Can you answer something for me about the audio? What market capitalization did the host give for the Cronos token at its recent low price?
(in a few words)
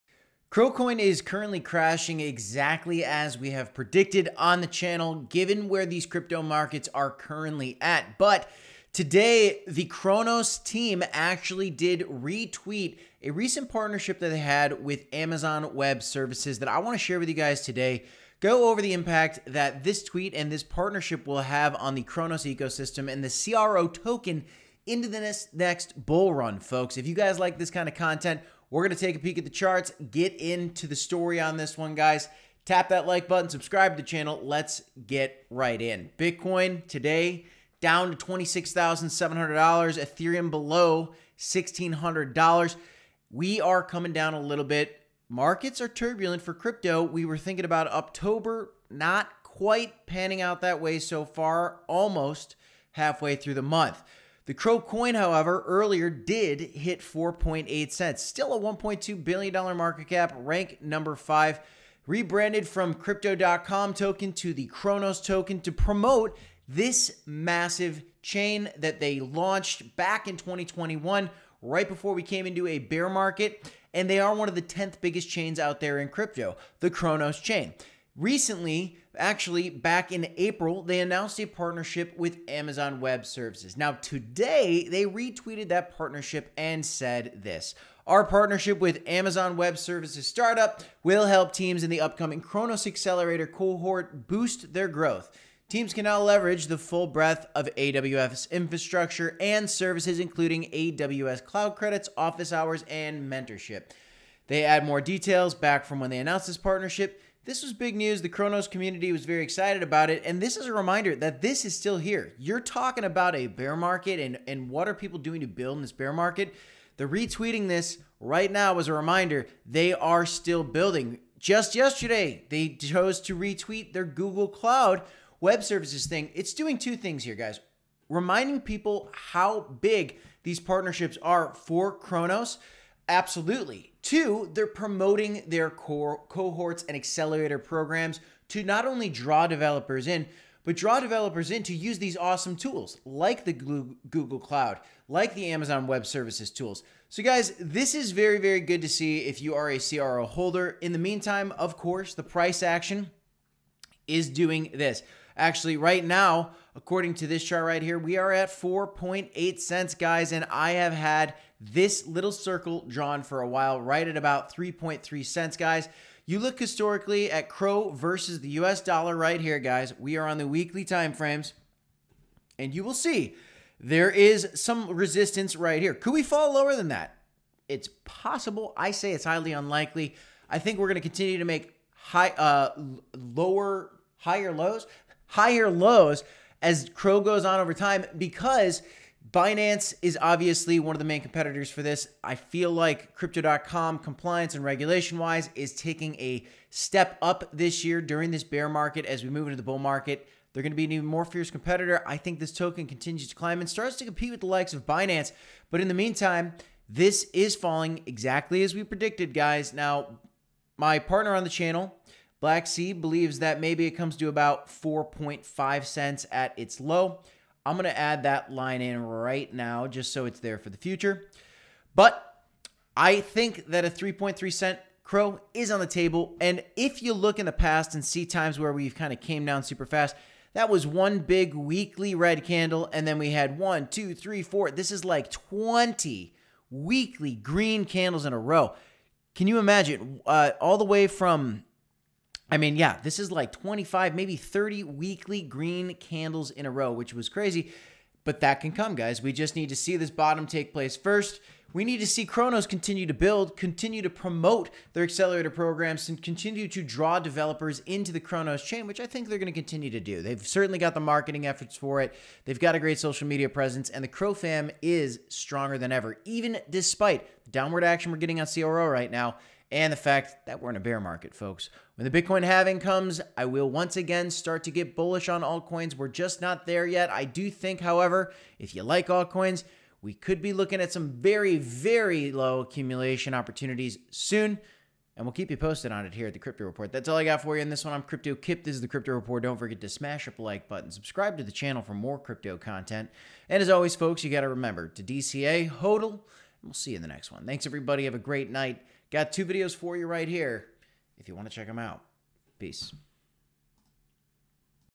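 $1.2 billion.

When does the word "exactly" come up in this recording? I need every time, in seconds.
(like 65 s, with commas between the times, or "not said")
2 s, 208 s.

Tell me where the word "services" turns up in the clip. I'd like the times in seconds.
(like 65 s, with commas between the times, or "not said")
16 s, 83 s, 89 s, 99 s, 125 s, 146 s.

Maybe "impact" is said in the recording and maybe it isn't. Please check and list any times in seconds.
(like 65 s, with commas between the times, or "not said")
18 s.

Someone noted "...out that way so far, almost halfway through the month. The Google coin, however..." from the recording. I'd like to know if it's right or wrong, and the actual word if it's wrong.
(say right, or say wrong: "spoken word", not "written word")
wrong: "CRO", not "Google".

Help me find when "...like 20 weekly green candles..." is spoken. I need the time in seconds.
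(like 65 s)
235 s.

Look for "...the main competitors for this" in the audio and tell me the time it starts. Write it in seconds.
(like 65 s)
190 s.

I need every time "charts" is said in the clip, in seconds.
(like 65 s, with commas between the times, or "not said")
29 s, 157 s.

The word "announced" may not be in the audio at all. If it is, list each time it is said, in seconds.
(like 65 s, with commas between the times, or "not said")
80 s, 106 s.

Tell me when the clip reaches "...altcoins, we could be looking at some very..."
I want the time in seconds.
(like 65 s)
279 s.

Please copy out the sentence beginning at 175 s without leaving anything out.
Could we fall lower than that?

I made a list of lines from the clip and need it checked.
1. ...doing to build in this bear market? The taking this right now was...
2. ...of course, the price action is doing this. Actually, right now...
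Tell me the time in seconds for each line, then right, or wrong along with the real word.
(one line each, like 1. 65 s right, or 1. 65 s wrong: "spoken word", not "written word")
1. 115 s wrong: "retweeting", not "taking"
2. 151 s right.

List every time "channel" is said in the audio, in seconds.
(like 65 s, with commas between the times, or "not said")
4 s, 34 s, 211 s, 291 s.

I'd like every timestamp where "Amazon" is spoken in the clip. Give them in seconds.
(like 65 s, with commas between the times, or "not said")
15 s, 82 s, 89 s, 145 s.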